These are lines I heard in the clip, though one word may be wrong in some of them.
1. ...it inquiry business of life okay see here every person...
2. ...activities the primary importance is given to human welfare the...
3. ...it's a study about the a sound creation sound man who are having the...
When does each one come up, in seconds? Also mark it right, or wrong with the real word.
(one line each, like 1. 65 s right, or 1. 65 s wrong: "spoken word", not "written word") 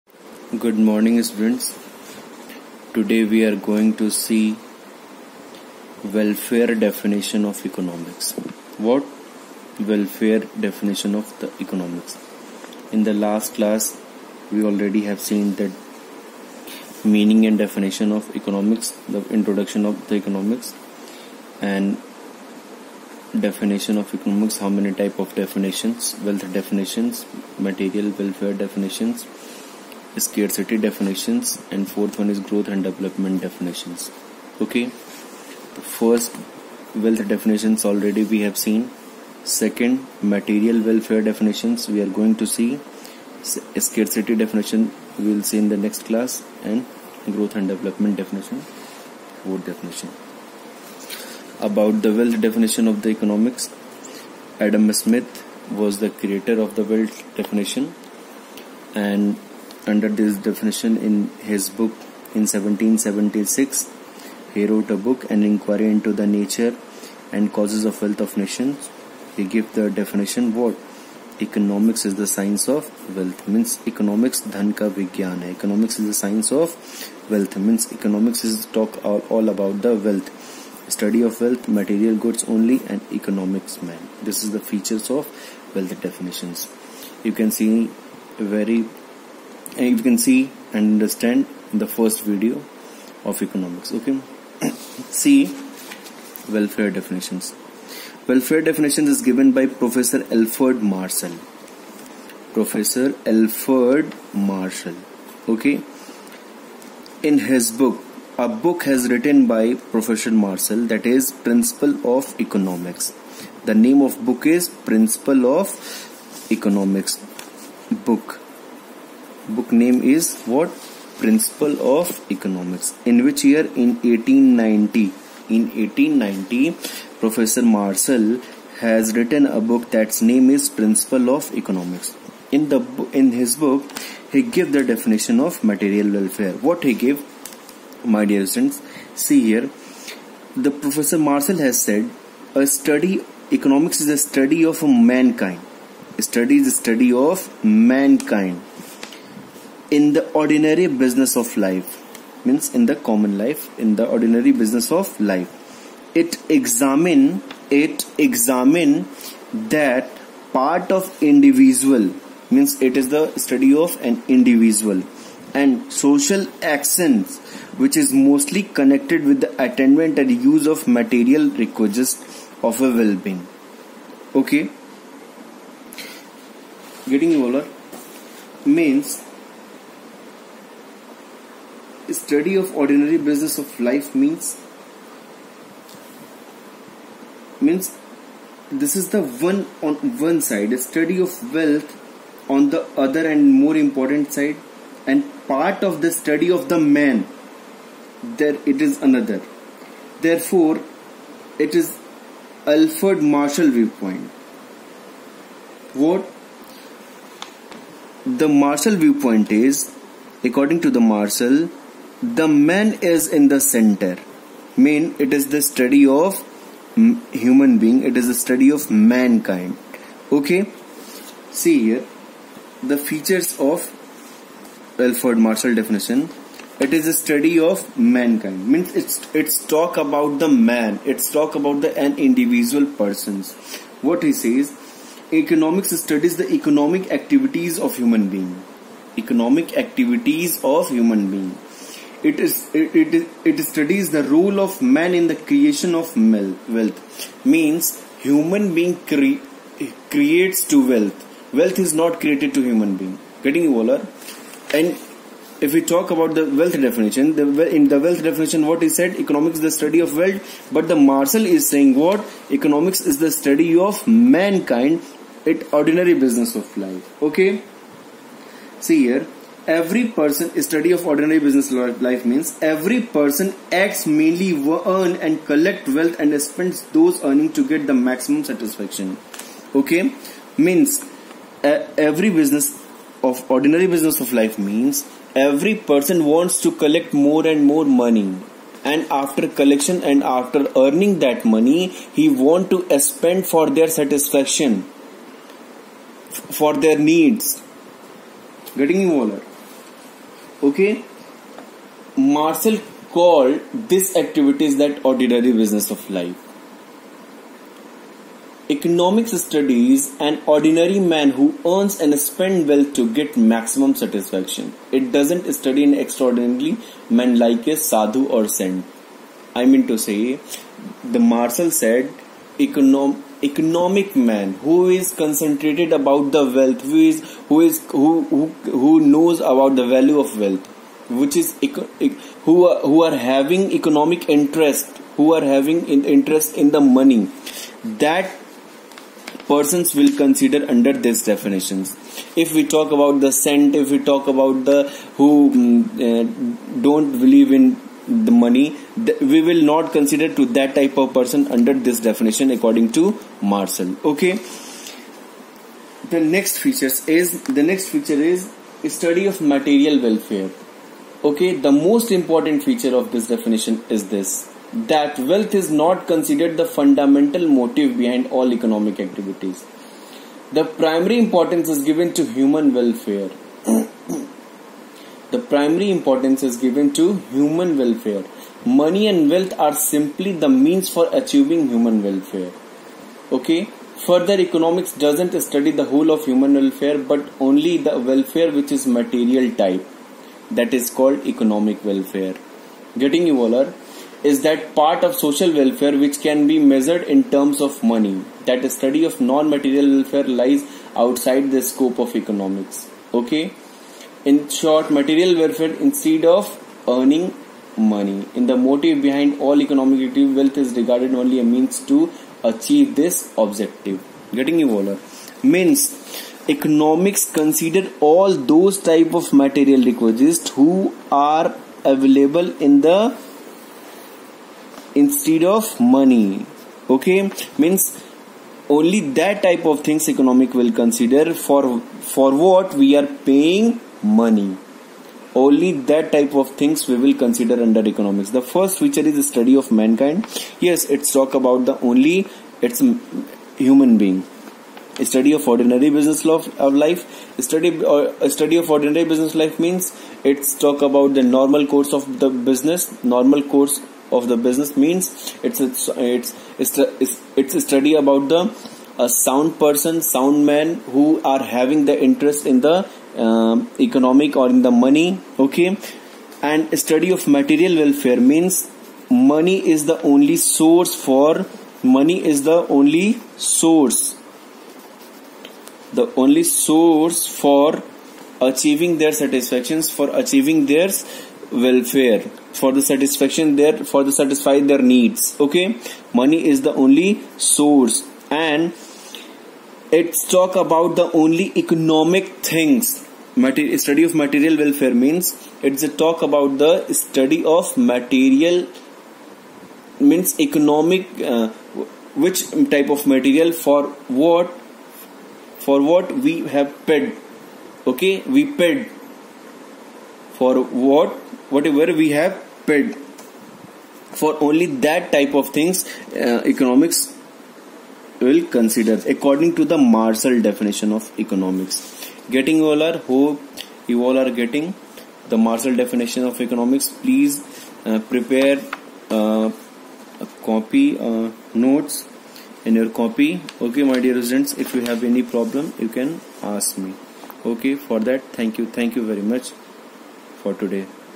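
1. 265 s wrong: "ordinary", not "inquiry"
2. 368 s right
3. 457 s wrong: "person", not "creation".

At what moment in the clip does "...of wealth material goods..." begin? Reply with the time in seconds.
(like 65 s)
81 s.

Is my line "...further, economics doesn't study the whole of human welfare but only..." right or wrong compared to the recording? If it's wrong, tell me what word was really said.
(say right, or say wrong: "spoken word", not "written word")
right.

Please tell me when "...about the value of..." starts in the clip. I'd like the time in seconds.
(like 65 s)
329 s.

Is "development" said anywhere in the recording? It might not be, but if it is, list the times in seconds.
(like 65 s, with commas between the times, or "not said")
32 s, 47 s.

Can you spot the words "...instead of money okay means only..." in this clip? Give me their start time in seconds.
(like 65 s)
424 s.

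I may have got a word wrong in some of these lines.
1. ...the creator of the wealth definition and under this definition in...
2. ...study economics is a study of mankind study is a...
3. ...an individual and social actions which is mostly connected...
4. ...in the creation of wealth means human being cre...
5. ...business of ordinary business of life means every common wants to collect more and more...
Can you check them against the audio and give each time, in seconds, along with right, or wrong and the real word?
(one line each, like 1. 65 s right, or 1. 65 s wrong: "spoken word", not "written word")
1. 55 s right
2. 142 s right
3. 164 s right
4. 245 s right
5. 282 s wrong: "person", not "common".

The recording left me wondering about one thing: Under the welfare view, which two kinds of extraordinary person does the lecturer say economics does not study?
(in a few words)
Sadhu or saint.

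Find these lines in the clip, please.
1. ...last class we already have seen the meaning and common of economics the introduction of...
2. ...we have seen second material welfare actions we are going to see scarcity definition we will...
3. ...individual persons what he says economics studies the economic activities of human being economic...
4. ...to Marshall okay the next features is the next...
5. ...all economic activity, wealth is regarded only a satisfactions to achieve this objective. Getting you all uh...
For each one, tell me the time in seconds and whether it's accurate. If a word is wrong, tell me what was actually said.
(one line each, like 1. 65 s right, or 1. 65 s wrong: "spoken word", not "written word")
1. 13 s wrong: "definition", not "common"
2. 38 s wrong: "definitions", not "actions"
3. 232 s right
4. 352 s right
5. 409 s wrong: "means", not "satisfactions".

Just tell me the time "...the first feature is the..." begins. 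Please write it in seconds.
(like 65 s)
438 s.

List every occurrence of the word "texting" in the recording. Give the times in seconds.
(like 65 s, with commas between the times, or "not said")
not said.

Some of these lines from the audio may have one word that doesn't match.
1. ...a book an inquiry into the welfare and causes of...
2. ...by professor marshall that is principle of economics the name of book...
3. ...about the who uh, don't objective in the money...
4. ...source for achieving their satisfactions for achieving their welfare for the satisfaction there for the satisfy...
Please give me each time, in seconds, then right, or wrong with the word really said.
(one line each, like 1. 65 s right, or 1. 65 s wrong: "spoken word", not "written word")
1. 64 s wrong: "nature", not "welfare"
2. 109 s right
3. 344 s wrong: "believe", not "objective"
4. 476 s right.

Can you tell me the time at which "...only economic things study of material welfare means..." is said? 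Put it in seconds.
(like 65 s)
491 s.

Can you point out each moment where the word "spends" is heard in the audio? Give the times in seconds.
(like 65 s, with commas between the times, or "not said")
276 s, 292 s, 312 s.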